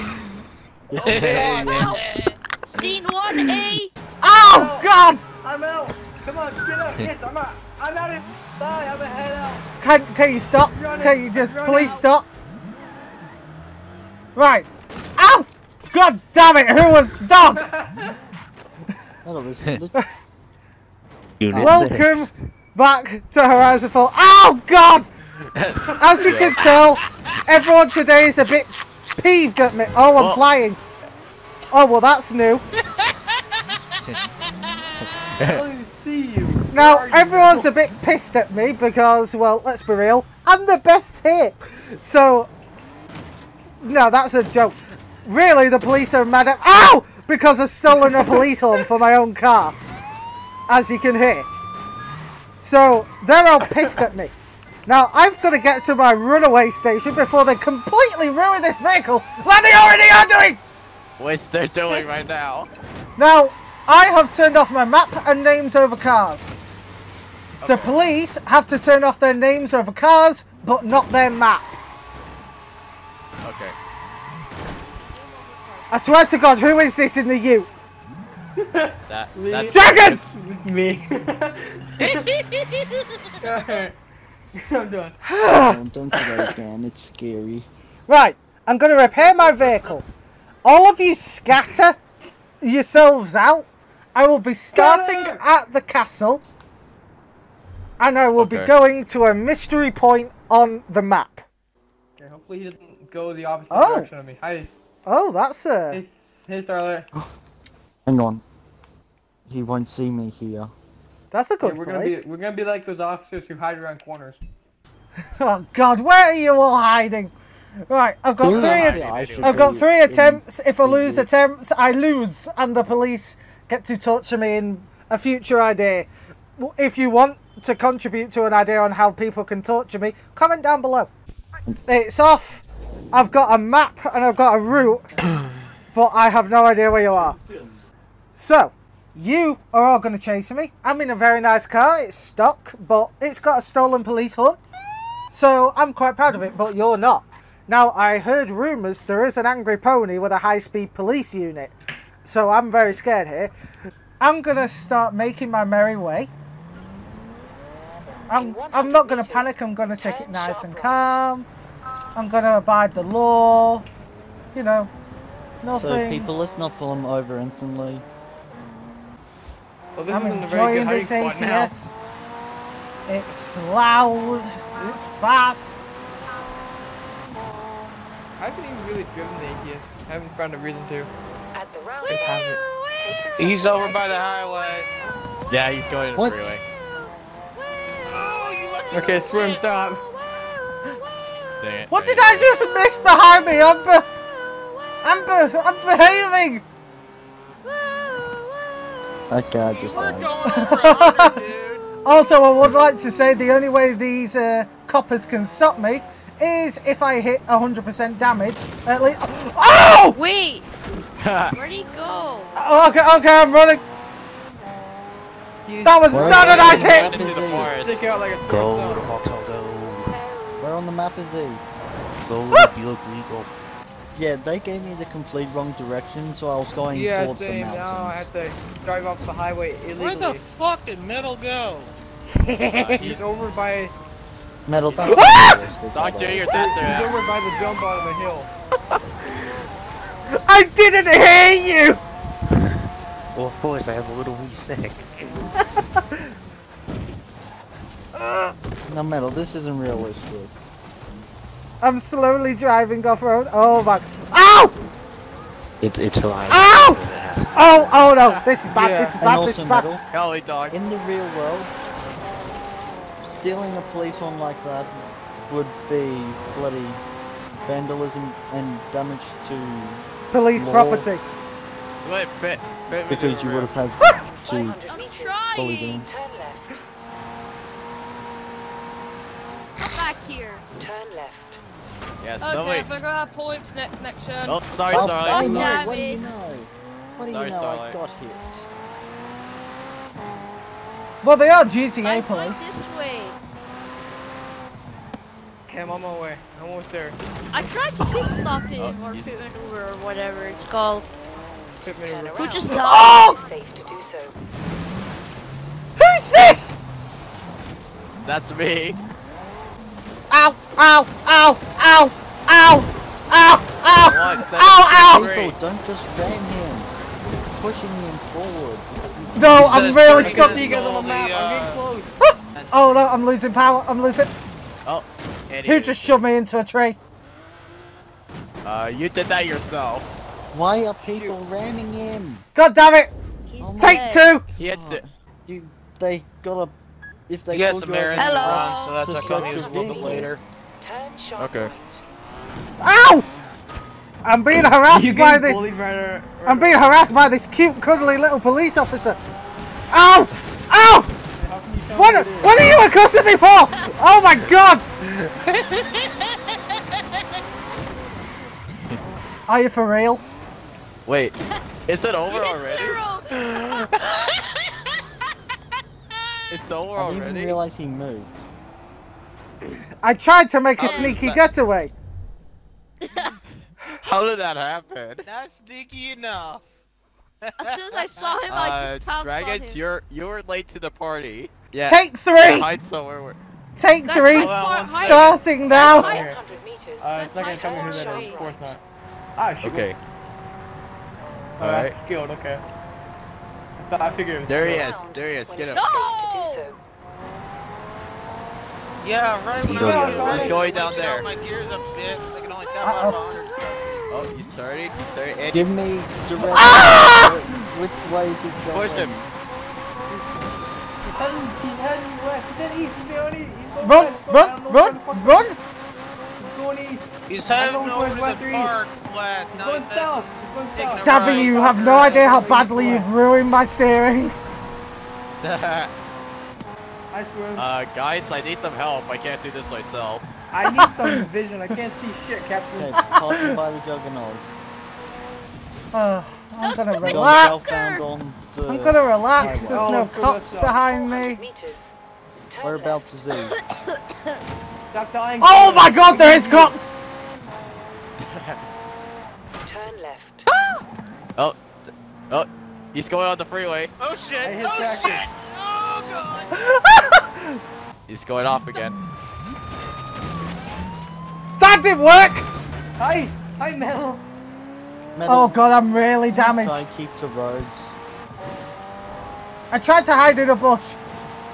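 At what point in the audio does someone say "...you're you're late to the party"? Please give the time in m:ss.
6:19.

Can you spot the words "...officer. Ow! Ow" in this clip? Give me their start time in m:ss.
5:48.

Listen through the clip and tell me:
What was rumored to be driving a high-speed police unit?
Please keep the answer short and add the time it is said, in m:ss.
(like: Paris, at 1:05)
Angry pony, at 2:29.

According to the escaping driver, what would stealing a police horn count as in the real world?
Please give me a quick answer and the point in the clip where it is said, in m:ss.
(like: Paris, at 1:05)
Vandalism, at 4:27.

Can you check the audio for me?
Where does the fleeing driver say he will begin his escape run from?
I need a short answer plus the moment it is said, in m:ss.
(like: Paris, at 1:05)
The castle, at 1:35.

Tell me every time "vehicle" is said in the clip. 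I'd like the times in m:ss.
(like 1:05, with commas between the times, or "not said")
0:58, 1:29.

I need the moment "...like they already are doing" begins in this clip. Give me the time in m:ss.
0:59.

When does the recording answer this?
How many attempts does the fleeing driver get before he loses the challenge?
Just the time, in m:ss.
1:59.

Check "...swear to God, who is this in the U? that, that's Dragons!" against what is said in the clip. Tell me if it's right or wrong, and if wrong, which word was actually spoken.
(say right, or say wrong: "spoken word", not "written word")
right.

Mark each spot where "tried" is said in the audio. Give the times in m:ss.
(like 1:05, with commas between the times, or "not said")
4:57, 6:10, 7:49.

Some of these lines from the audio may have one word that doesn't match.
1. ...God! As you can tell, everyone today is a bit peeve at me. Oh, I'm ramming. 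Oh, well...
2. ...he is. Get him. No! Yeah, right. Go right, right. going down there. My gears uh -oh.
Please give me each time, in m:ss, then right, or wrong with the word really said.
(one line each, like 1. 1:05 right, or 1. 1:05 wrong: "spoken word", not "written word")
1. 0:24 wrong: "flying", not "ramming"
2. 6:35 right.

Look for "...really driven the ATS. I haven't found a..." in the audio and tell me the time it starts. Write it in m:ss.
2:58.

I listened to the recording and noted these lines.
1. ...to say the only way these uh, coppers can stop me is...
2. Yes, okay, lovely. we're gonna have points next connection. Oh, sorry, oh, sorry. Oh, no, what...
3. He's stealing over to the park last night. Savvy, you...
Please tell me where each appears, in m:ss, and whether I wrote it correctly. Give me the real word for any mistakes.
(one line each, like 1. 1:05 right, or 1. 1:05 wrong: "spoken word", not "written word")
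1. 3:23 right
2. 4:42 right
3. 6:57 wrong: "heading", not "stealing".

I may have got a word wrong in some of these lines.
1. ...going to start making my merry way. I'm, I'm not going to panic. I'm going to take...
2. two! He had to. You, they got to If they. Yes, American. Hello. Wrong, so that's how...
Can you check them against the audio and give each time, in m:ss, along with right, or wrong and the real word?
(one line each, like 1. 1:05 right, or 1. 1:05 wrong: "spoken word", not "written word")
1. 2:34 right
2. 5:34 right.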